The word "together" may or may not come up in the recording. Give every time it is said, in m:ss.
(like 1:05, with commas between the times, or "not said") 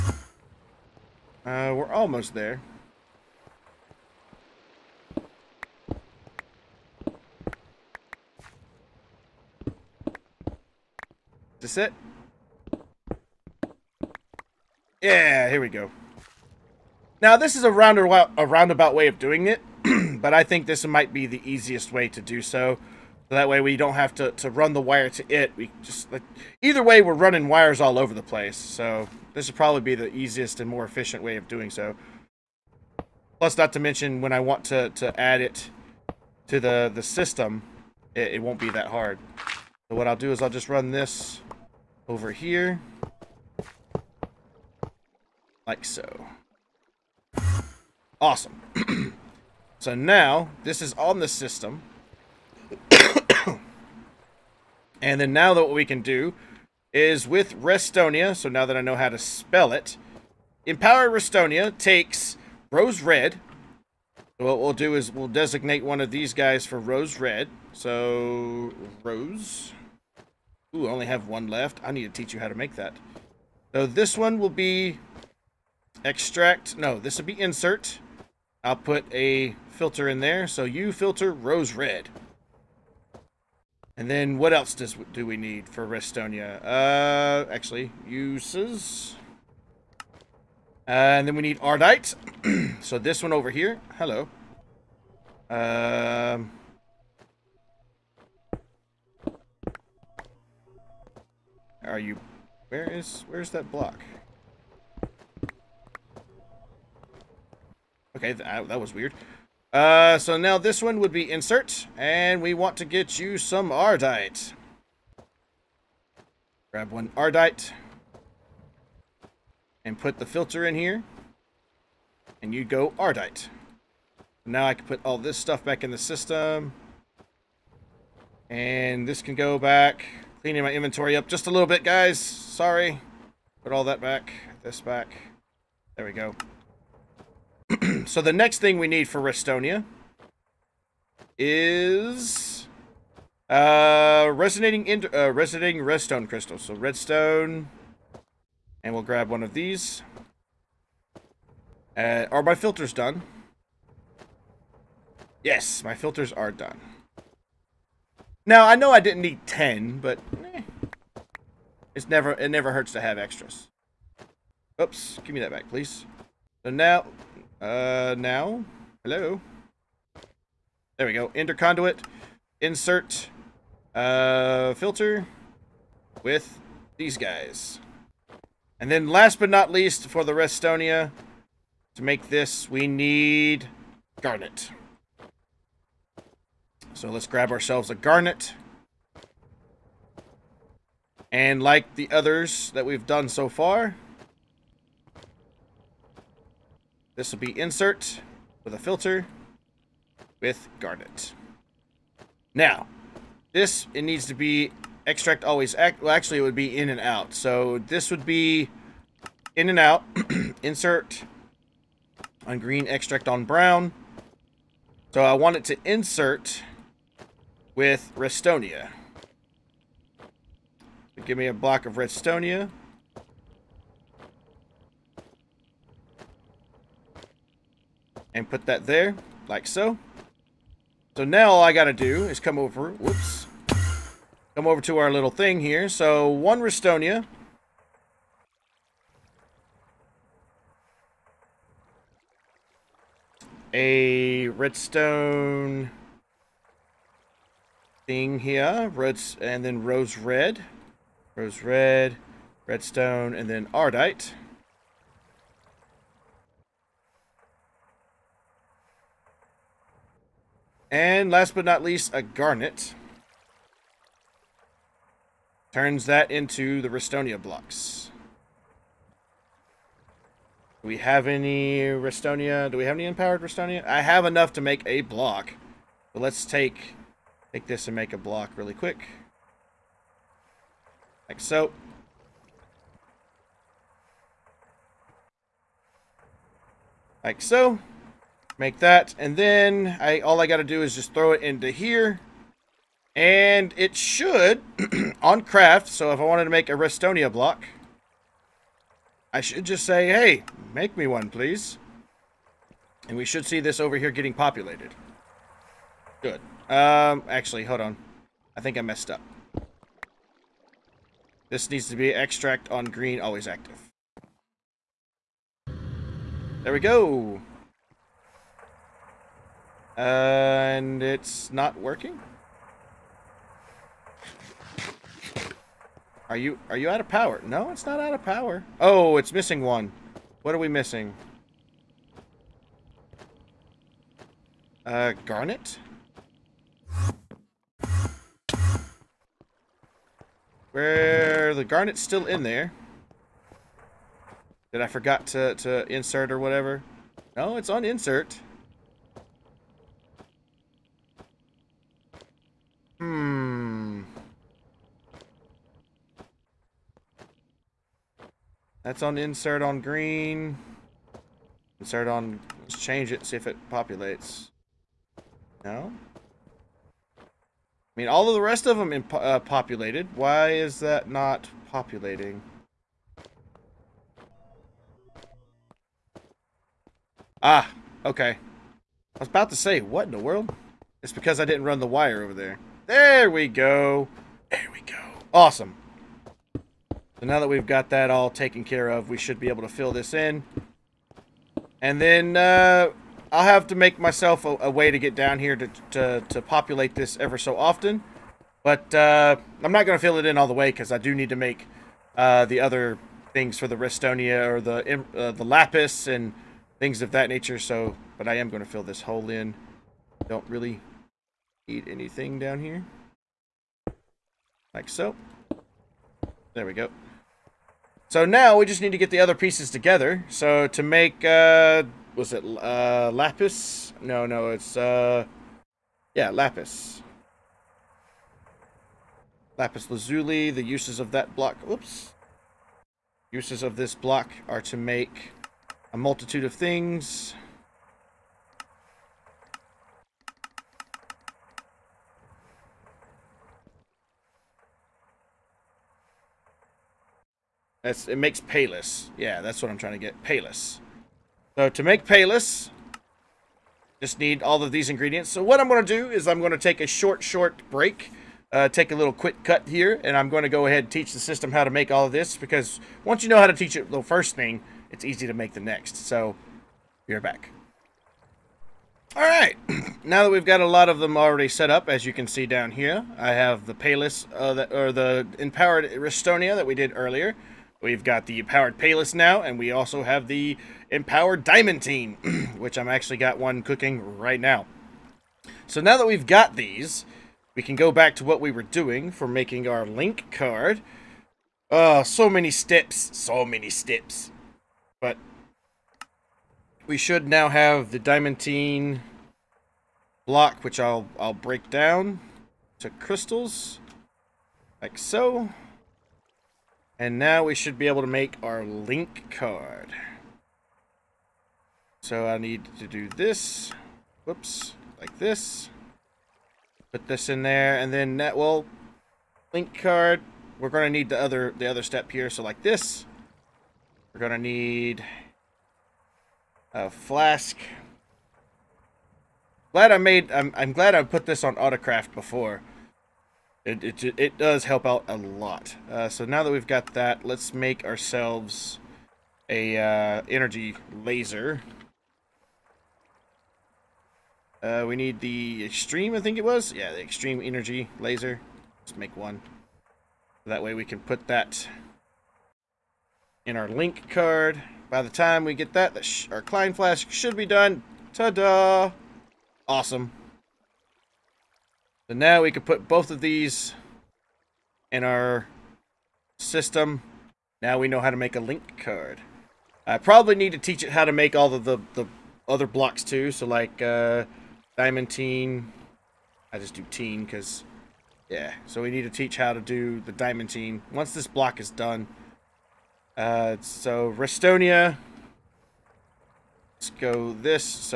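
6:59.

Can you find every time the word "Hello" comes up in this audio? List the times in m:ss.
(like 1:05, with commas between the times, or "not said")
1:33, 2:49.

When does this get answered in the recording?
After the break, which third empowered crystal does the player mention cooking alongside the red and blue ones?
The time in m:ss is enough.
8:00.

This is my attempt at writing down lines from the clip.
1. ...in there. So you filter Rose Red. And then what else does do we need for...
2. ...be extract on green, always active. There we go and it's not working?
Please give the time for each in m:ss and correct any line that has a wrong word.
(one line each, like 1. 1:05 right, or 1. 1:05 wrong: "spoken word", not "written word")
1. 1:20 right
2. 5:11 right.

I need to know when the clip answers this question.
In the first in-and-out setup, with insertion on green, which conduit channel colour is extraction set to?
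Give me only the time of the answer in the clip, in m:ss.
3:33.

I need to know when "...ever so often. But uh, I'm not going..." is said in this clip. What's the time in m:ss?
6:37.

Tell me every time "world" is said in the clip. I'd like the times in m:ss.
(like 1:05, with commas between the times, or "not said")
6:20.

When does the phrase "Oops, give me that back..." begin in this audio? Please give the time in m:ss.
2:44.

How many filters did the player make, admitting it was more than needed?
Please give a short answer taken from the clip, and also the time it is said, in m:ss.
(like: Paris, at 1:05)
10, at 2:39.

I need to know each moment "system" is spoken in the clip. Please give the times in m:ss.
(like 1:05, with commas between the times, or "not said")
0:37, 0:51, 2:05, 7:41, 9:26.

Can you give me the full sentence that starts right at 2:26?
So redstone, and we'll grab one of these.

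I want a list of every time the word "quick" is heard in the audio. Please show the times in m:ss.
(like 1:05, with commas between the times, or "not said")
4:38, 7:39.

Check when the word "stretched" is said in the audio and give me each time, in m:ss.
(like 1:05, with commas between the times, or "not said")
not said.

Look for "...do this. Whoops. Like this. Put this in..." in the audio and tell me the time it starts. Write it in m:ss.
8:32.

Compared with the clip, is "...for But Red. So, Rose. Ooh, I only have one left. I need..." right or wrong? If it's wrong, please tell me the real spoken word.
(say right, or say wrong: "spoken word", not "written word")
wrong: "Rose", not "But".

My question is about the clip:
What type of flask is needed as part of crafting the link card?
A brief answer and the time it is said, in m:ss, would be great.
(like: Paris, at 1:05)
Klein Flask, at 9:16.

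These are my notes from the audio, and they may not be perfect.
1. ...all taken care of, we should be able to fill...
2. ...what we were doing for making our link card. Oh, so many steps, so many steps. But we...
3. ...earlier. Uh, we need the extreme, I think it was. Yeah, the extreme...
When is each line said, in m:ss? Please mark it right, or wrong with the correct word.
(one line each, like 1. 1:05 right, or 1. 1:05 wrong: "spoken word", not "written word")
1. 6:28 right
2. 8:08 right
3. 9:01 wrong: "laser", not "earlier".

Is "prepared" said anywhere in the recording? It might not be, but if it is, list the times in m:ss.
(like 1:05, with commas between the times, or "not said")
not said.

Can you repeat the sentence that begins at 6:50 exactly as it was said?
Don't really eat anything down here.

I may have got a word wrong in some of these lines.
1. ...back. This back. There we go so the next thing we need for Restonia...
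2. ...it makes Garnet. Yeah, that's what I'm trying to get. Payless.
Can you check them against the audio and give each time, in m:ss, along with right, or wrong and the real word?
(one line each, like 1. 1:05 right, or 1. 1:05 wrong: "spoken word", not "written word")
1. 2:14 right
2. 7:28 wrong: "Payless", not "Garnet".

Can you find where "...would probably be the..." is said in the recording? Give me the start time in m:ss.
0:29.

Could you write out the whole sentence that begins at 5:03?
And we should see this over here getting populated.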